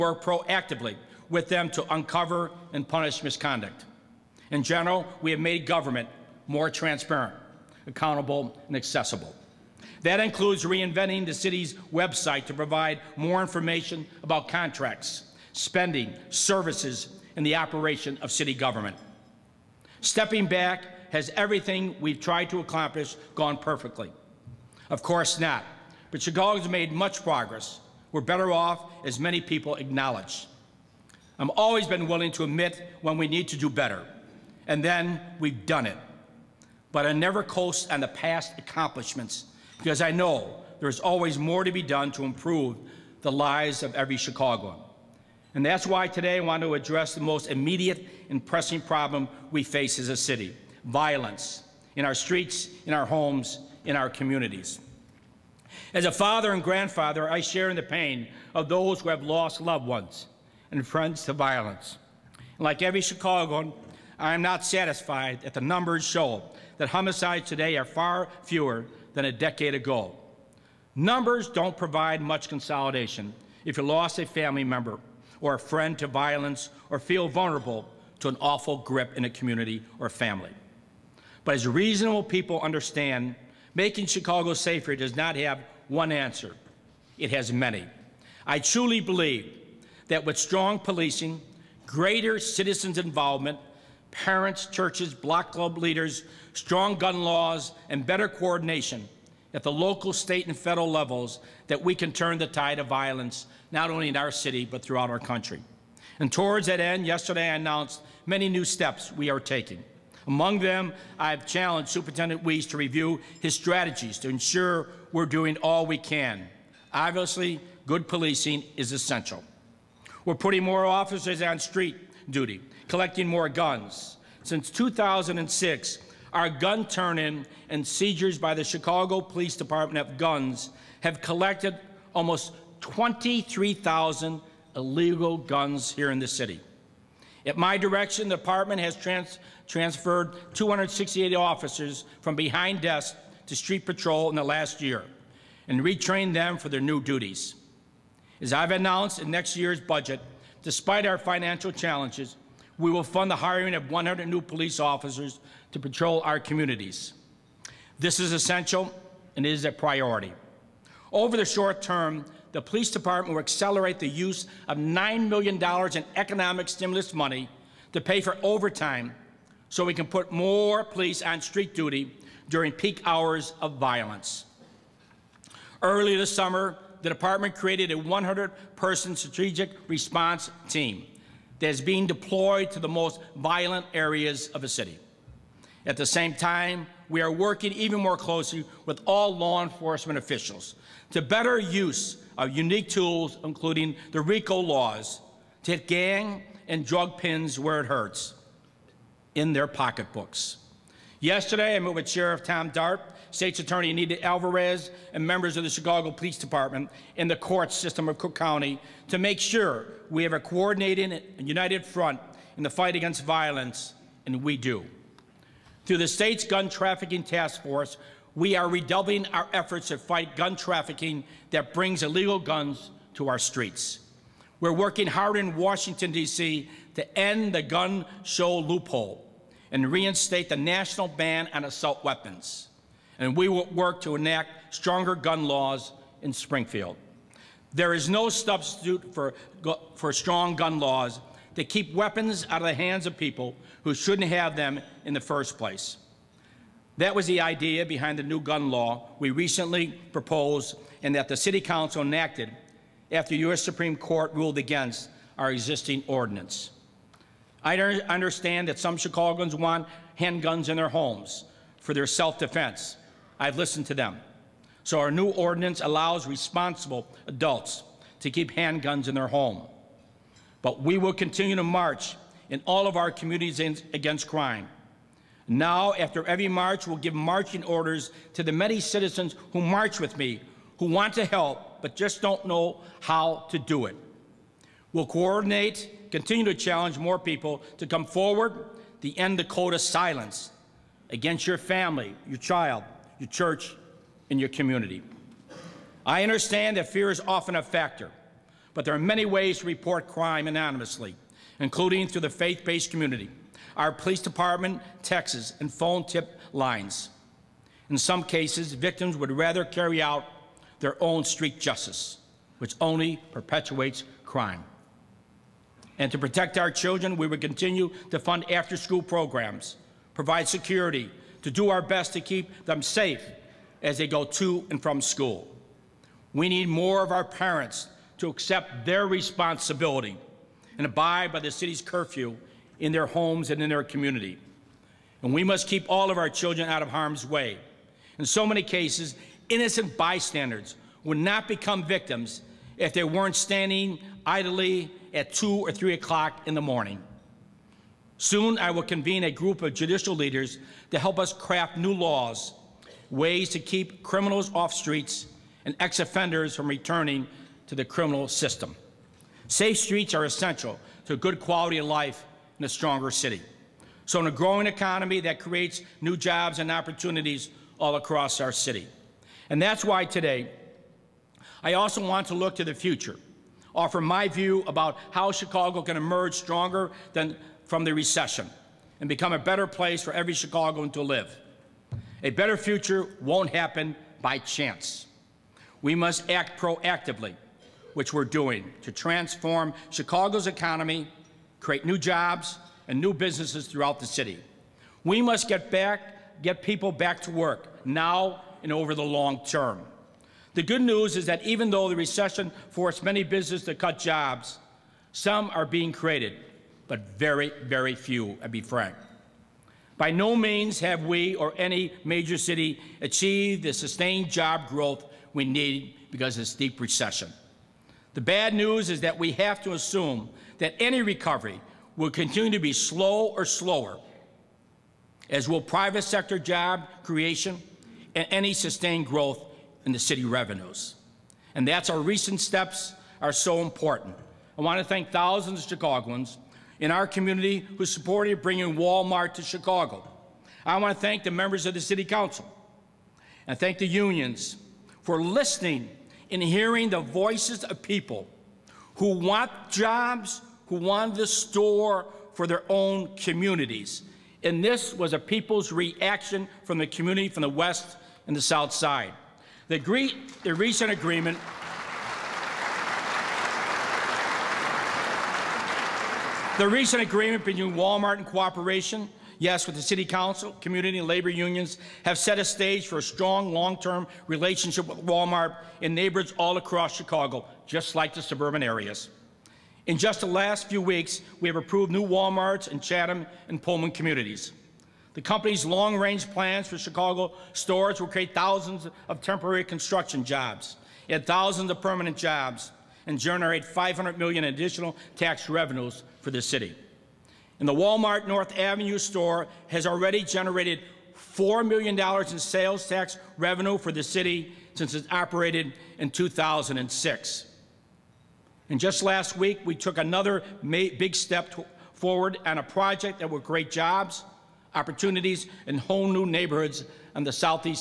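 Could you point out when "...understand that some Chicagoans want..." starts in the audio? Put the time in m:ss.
4:17.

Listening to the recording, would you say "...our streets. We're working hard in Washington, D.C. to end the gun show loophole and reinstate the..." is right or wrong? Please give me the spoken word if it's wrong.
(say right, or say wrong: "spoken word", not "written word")
right.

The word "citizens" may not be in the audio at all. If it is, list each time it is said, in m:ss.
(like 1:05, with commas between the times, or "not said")
1:32, 4:38.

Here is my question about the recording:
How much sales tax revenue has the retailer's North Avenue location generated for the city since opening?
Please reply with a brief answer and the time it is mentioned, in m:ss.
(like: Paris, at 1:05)
$4 million, at 8:21.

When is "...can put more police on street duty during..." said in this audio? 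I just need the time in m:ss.
2:49.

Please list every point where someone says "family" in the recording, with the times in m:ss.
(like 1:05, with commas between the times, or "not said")
1:14, 1:20, 4:51.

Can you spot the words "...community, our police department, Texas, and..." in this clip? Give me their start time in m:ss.
5:02.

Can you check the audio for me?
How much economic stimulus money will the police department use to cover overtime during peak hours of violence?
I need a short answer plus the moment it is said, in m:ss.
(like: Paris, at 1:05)
$9 million, at 2:44.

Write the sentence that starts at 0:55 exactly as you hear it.
As a father and grandfather, I share in the pain of those who have lost loved ones and friends to violence.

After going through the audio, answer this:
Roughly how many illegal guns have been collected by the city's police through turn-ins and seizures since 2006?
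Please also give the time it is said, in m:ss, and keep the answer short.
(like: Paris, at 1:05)
23,000, at 2:12.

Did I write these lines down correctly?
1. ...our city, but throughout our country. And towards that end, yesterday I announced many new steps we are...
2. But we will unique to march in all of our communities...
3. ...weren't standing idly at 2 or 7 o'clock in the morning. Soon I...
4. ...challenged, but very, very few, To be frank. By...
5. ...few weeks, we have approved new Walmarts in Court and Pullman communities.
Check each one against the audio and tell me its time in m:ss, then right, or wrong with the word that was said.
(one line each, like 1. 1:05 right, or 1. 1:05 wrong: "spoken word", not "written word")
1. 1:44 right
2. 4:30 wrong: "continue", not "unique"
3. 5:43 wrong: "3", not "7"
4. 6:45 wrong: "created", not "challenged"
5. 8:00 wrong: "Chatham", not "Court".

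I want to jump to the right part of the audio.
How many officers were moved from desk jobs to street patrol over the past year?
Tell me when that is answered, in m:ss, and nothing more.
2:20.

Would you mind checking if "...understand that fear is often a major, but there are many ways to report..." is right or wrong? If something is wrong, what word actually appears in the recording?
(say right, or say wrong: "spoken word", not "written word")
wrong: "factor", not "major".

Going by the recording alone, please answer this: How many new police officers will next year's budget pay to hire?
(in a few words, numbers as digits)
100.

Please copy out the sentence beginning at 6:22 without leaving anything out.
A better future won't happen by chance.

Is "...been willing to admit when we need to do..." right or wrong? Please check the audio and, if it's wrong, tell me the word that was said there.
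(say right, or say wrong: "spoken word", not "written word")
right.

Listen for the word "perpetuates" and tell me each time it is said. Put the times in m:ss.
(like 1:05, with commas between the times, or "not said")
5:13.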